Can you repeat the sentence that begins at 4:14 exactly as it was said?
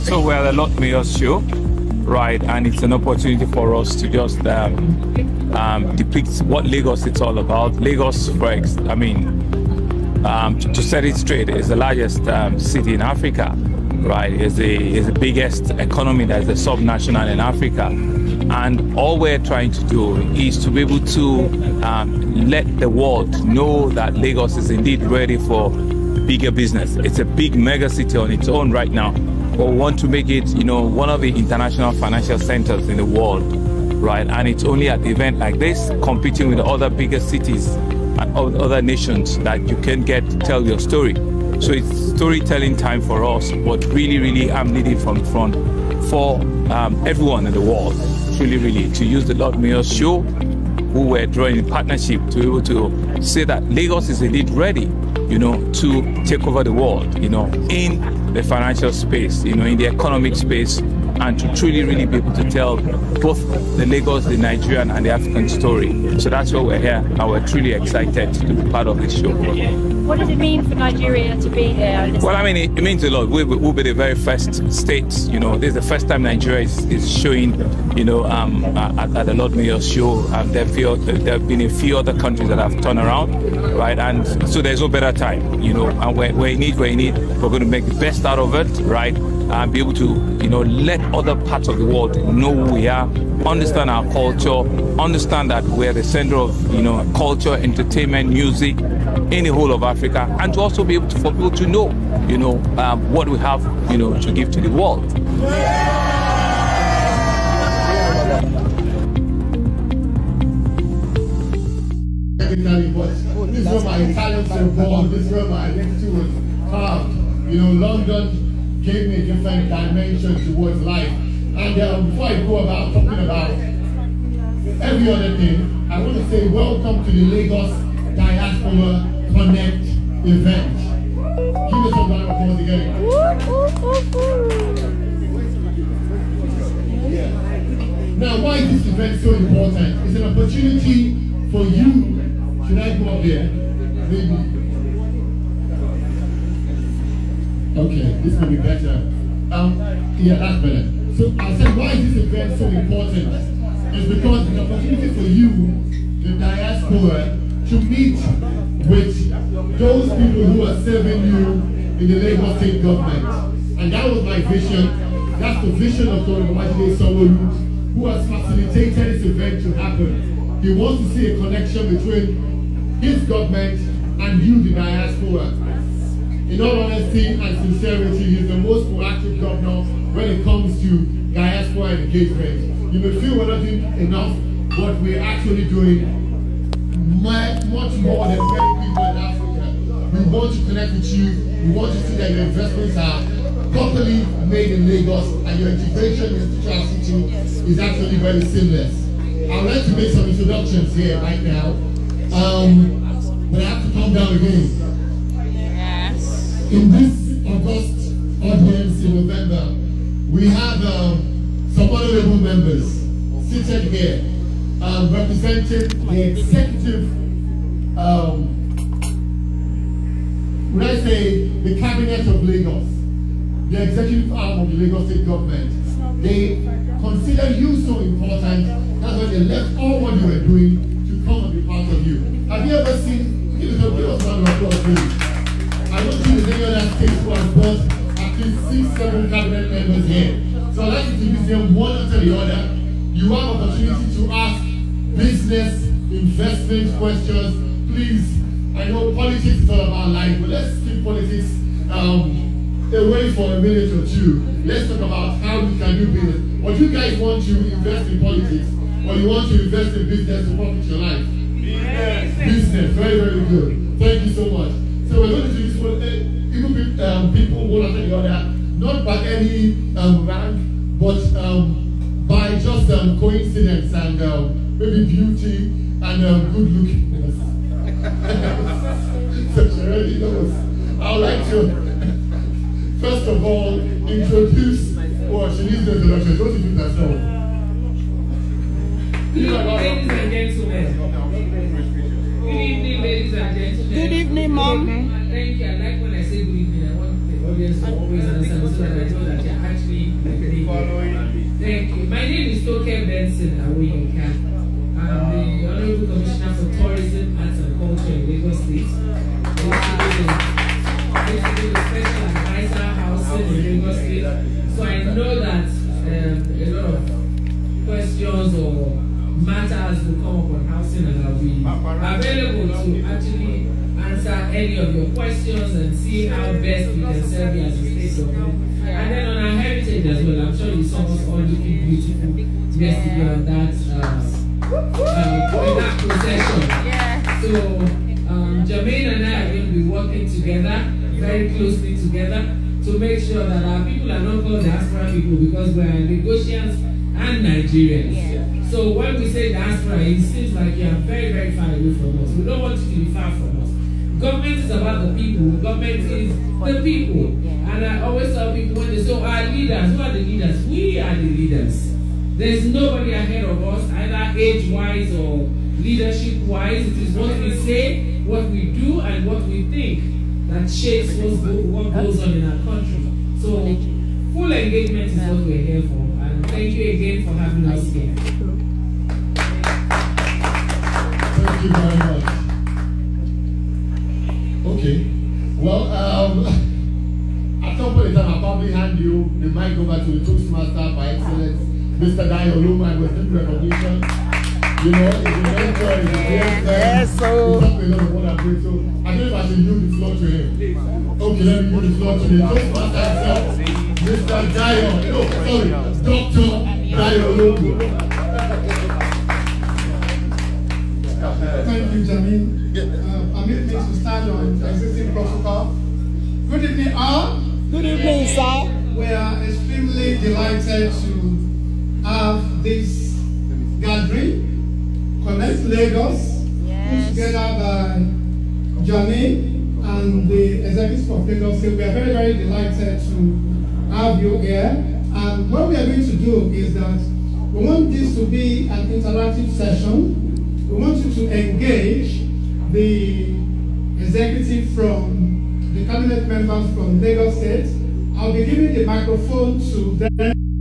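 Let's talk about how we can do business.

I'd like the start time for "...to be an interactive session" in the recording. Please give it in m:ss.
7:18.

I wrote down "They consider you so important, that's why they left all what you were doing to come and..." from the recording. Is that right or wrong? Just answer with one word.
right.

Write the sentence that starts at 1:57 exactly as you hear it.
You know, London gave me a different dimension towards life.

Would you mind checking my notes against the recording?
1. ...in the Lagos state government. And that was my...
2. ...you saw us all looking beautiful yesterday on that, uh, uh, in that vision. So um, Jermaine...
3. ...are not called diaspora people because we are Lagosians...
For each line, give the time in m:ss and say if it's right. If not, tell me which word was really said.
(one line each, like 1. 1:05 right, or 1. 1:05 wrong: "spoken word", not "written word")
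1. 2:41 right
2. 5:30 wrong: "procession", not "vision"
3. 5:44 right.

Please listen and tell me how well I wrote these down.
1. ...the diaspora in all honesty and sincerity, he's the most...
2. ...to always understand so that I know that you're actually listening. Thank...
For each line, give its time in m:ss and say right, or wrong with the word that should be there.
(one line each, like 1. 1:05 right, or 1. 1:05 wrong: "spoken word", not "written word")
1. 2:54 right
2. 4:57 right.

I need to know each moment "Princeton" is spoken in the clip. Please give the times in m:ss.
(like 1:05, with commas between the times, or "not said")
not said.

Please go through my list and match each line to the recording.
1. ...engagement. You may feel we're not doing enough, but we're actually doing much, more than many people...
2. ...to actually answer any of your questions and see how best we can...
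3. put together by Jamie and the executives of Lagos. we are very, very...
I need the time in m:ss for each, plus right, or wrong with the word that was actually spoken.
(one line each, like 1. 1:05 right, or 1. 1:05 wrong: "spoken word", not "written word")
1. 3:02 right
2. 5:22 right
3. 7:07 right.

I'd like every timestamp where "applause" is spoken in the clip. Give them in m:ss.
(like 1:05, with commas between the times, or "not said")
2:12, 3:54.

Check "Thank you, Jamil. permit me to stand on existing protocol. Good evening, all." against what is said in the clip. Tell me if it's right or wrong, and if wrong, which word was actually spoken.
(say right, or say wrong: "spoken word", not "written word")
right.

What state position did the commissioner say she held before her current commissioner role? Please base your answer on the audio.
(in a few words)
Special Advisor Housing.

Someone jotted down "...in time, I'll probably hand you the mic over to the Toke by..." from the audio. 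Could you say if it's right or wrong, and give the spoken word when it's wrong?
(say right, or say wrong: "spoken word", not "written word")
wrong: "Toastmaster", not "Toke".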